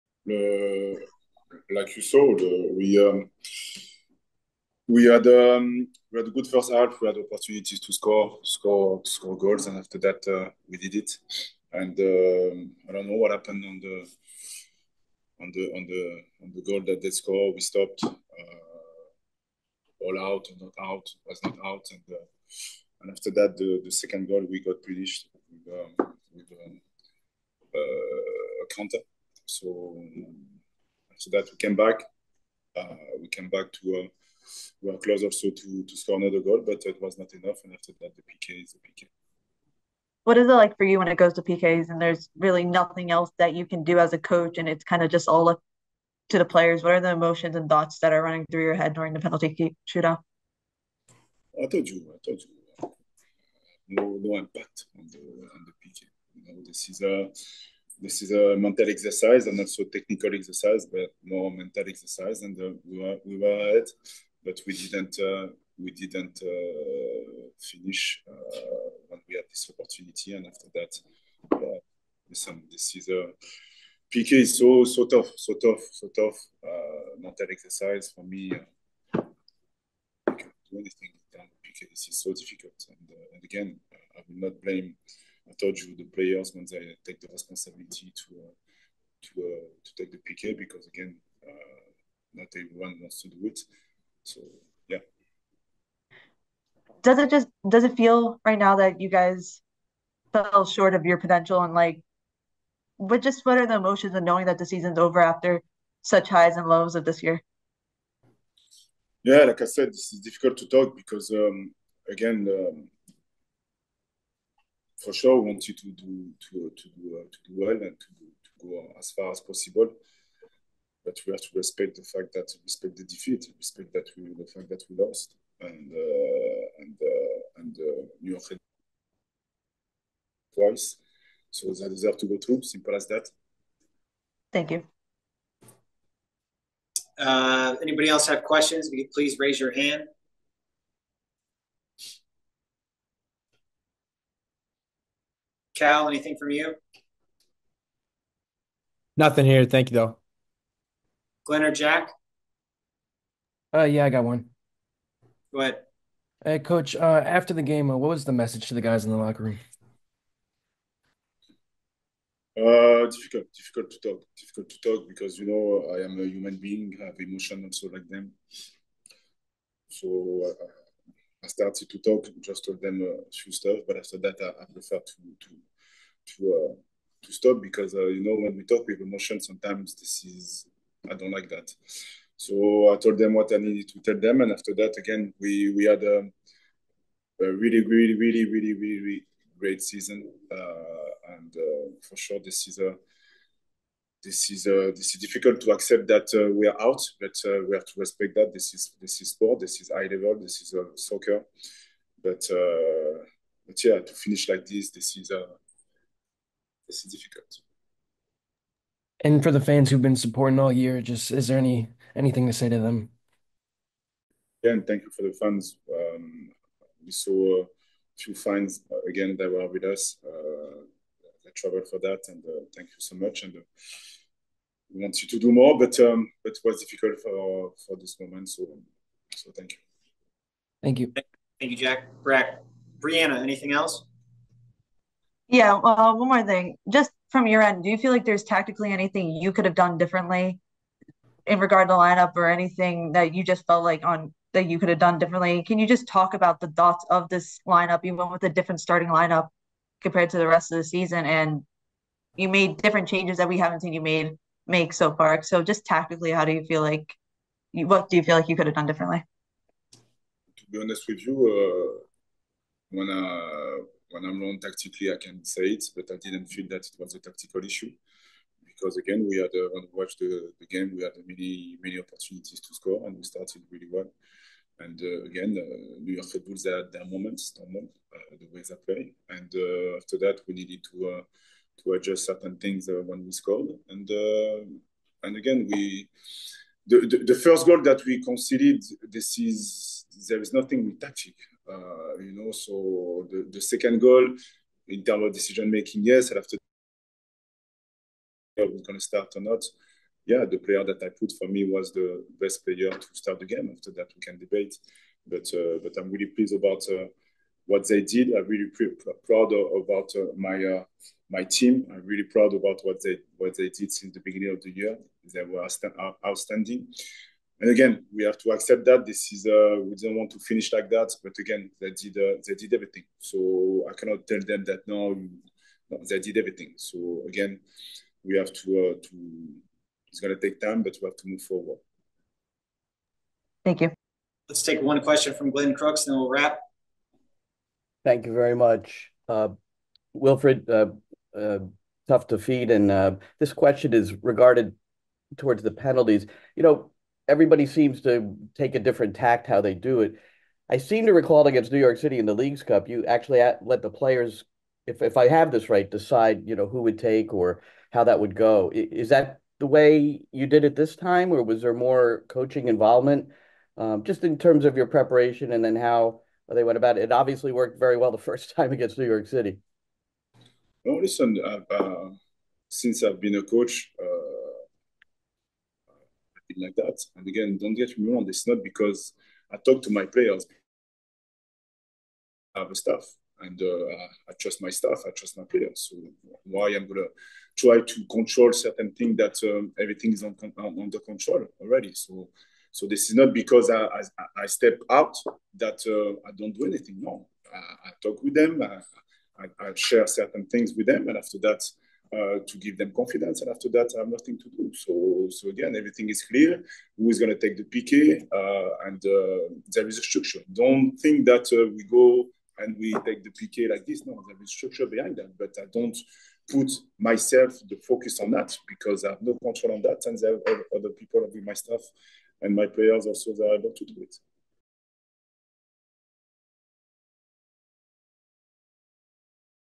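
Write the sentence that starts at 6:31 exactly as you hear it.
So so this is not because I I, I step out that uh, I don't do anything.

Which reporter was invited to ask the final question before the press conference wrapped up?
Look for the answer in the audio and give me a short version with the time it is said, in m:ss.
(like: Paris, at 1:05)
Glenn Crooks, at 5:35.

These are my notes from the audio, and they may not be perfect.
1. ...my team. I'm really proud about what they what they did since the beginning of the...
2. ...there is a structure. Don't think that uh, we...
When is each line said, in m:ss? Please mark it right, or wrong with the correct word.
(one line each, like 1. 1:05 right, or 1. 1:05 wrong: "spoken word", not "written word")
1. 5:11 right
2. 6:49 right.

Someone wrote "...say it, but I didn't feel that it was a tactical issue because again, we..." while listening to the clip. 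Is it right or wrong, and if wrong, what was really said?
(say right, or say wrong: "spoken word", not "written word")
right.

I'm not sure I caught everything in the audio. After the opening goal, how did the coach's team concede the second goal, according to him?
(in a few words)
a counter.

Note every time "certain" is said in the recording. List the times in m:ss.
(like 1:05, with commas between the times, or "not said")
4:42, 6:28, 6:40.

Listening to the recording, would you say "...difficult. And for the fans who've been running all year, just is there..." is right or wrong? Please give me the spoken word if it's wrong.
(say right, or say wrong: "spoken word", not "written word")
wrong: "supporting", not "running".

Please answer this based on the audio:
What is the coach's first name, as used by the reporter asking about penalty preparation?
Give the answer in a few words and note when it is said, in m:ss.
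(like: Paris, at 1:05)
Wilfried, at 5:40.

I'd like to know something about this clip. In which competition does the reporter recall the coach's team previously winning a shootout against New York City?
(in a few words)
Leagues Cup.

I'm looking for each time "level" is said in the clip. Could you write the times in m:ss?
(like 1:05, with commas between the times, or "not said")
3:20.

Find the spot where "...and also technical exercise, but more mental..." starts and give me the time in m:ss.
0:59.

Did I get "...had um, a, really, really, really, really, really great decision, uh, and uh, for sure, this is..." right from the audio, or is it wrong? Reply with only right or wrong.
wrong.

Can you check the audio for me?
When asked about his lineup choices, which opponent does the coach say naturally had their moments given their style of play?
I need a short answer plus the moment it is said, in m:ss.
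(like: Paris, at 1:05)
New York Red Bulls, at 4:36.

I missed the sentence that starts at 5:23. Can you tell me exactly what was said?
So I cannot tell them that no, no they did everything.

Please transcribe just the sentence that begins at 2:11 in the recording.
So they deserve to go through.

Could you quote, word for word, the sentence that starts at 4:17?
What do you feel like you could have done differently?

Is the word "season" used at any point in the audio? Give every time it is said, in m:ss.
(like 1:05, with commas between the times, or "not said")
1:44, 3:09, 4:10.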